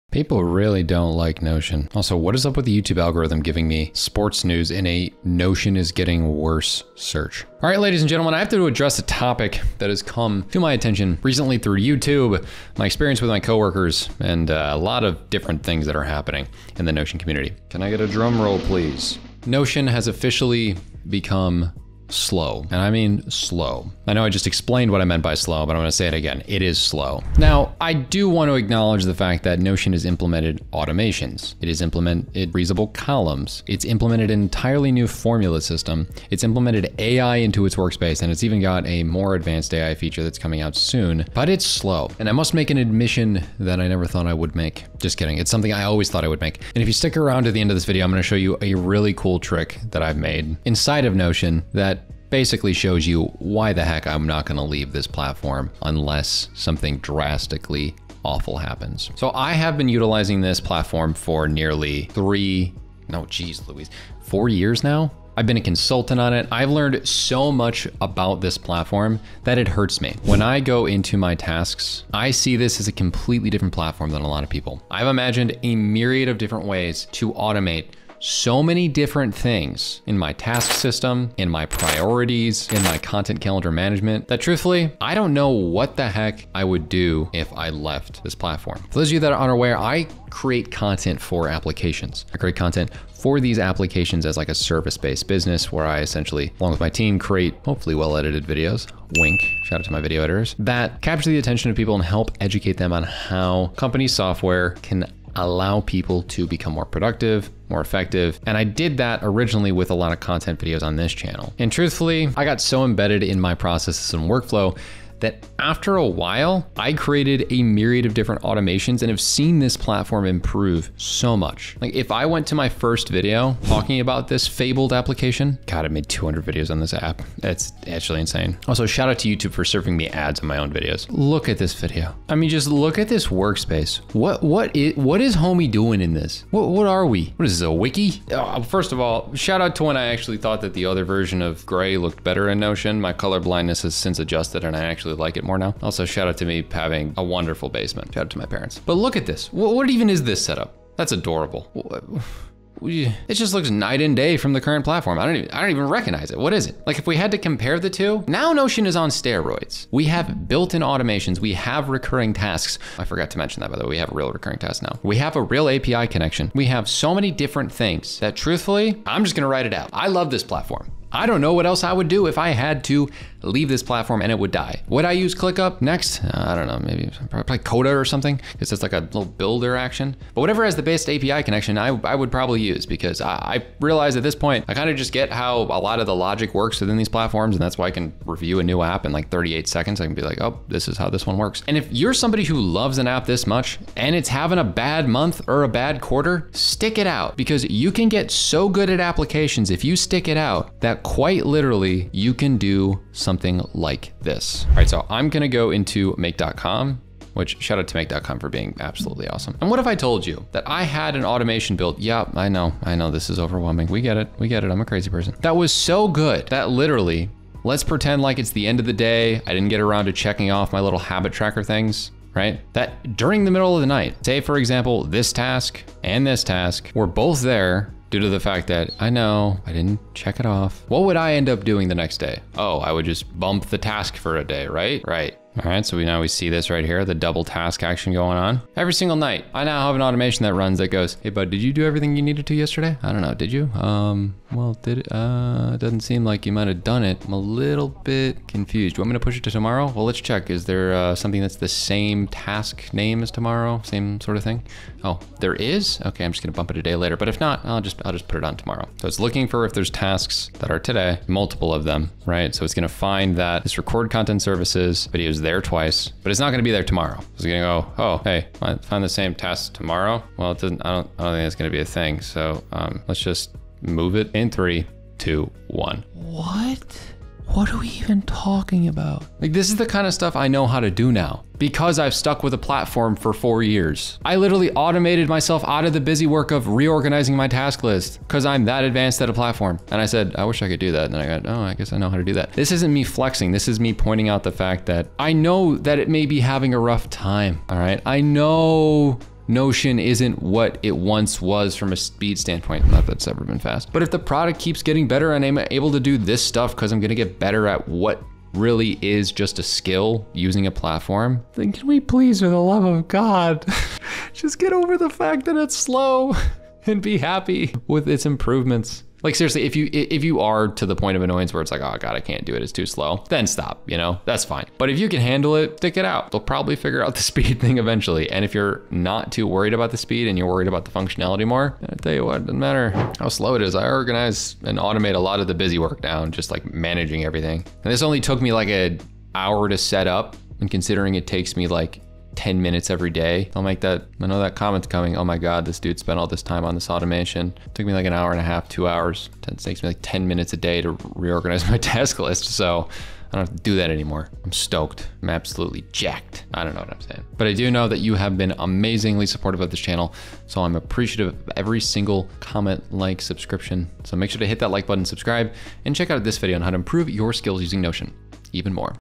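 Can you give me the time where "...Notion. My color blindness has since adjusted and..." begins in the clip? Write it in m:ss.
2:22.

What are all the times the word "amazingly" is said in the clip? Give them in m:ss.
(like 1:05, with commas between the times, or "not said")
5:58.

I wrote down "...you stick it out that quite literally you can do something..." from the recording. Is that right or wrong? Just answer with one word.
right.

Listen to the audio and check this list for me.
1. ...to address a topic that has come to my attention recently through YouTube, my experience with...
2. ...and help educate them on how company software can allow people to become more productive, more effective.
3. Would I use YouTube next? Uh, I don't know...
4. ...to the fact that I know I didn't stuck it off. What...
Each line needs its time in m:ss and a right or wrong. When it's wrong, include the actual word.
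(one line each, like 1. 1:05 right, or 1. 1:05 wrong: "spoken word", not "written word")
1. 0:08 right
2. 1:41 right
3. 2:54 wrong: "ClickUp", not "YouTube"
4. 3:48 wrong: "check", not "stuck".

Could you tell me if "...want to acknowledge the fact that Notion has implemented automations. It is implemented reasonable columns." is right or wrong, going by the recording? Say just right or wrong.
right.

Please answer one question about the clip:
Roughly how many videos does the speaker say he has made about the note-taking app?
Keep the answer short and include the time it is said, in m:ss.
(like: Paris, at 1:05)
200, at 2:06.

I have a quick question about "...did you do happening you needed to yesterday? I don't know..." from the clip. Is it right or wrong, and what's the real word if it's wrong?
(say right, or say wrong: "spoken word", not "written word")
wrong: "everything", not "happening".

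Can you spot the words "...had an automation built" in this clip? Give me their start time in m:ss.
3:30.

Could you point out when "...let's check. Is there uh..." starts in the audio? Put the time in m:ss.
4:10.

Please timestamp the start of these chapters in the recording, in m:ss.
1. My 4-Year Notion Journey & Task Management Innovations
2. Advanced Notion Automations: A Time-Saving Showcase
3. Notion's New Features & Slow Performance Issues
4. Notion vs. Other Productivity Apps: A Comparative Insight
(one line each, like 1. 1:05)
1. 1:00
2. 3:00
3. 0:30
4. 2:00.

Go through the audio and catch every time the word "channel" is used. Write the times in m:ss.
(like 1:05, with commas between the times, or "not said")
1:51, 5:59.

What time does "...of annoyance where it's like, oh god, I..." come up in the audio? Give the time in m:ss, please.
5:21.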